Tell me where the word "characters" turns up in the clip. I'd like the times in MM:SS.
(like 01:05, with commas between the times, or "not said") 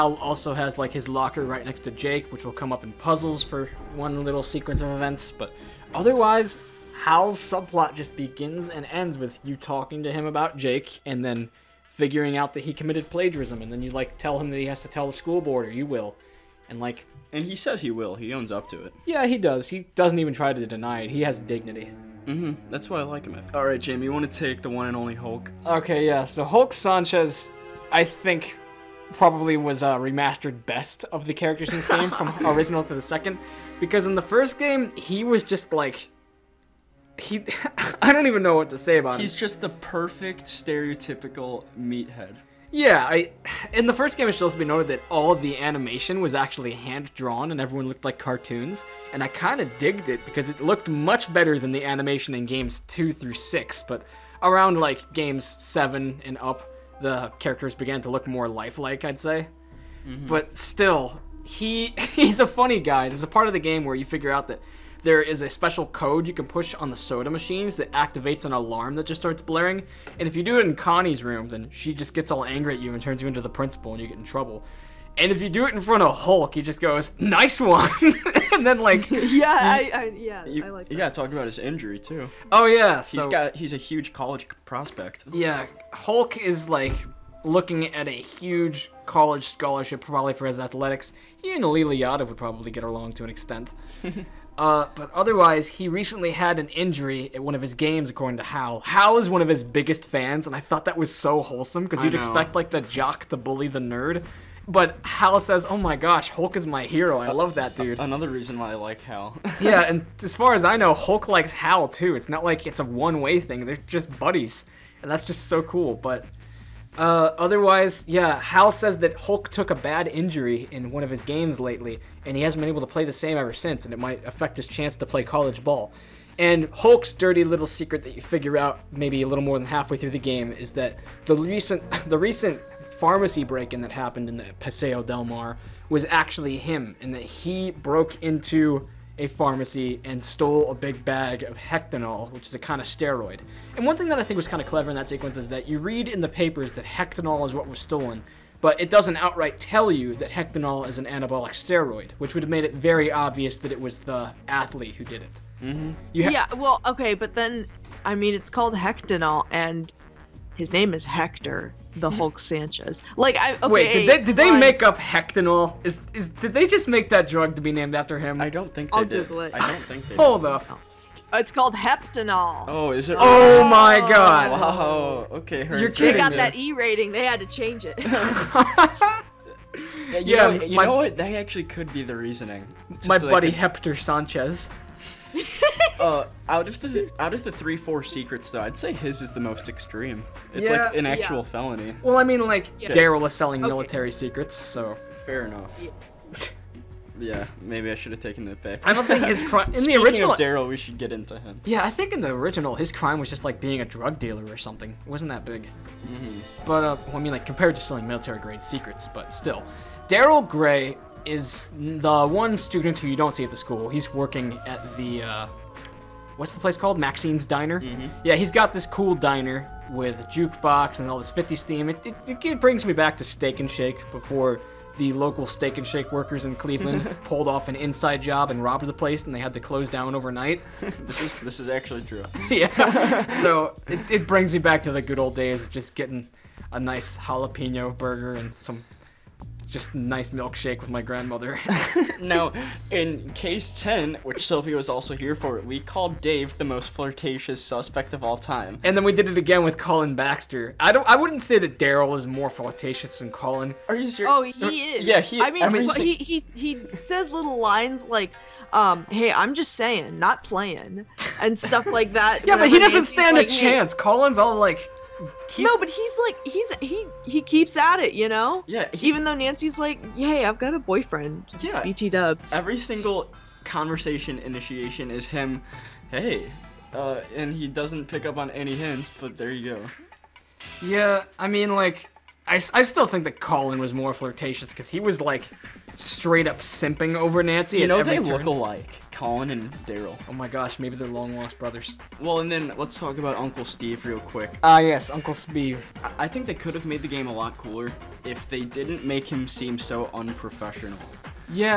00:31, 00:57.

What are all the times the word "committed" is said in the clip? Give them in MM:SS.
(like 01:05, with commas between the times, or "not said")
00:12.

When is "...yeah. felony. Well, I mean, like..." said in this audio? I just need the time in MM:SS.
03:11.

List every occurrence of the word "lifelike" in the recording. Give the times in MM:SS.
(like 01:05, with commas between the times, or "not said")
00:58.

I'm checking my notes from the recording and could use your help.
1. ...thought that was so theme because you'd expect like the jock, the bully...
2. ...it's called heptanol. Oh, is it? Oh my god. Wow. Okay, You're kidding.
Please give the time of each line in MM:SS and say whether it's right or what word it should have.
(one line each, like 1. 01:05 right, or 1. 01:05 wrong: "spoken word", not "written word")
1. 01:40 wrong: "wholesome", not "theme"
2. 02:51 right.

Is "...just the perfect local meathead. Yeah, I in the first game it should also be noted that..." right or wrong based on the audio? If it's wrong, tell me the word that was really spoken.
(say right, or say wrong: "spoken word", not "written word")
wrong: "stereotypical", not "local".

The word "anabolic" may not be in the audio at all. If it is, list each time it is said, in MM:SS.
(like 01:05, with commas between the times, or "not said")
02:31.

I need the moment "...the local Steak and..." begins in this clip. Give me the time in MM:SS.
03:44.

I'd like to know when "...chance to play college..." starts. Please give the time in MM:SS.
02:04.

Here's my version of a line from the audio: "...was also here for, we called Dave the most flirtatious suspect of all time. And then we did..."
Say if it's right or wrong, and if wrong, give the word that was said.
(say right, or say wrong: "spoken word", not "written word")
right.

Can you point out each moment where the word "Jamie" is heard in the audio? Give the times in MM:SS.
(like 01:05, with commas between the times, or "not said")
00:23.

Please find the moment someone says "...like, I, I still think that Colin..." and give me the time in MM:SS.
04:41.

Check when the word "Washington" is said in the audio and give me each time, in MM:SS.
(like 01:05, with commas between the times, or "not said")
not said.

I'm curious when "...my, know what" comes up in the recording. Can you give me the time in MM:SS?
03:00.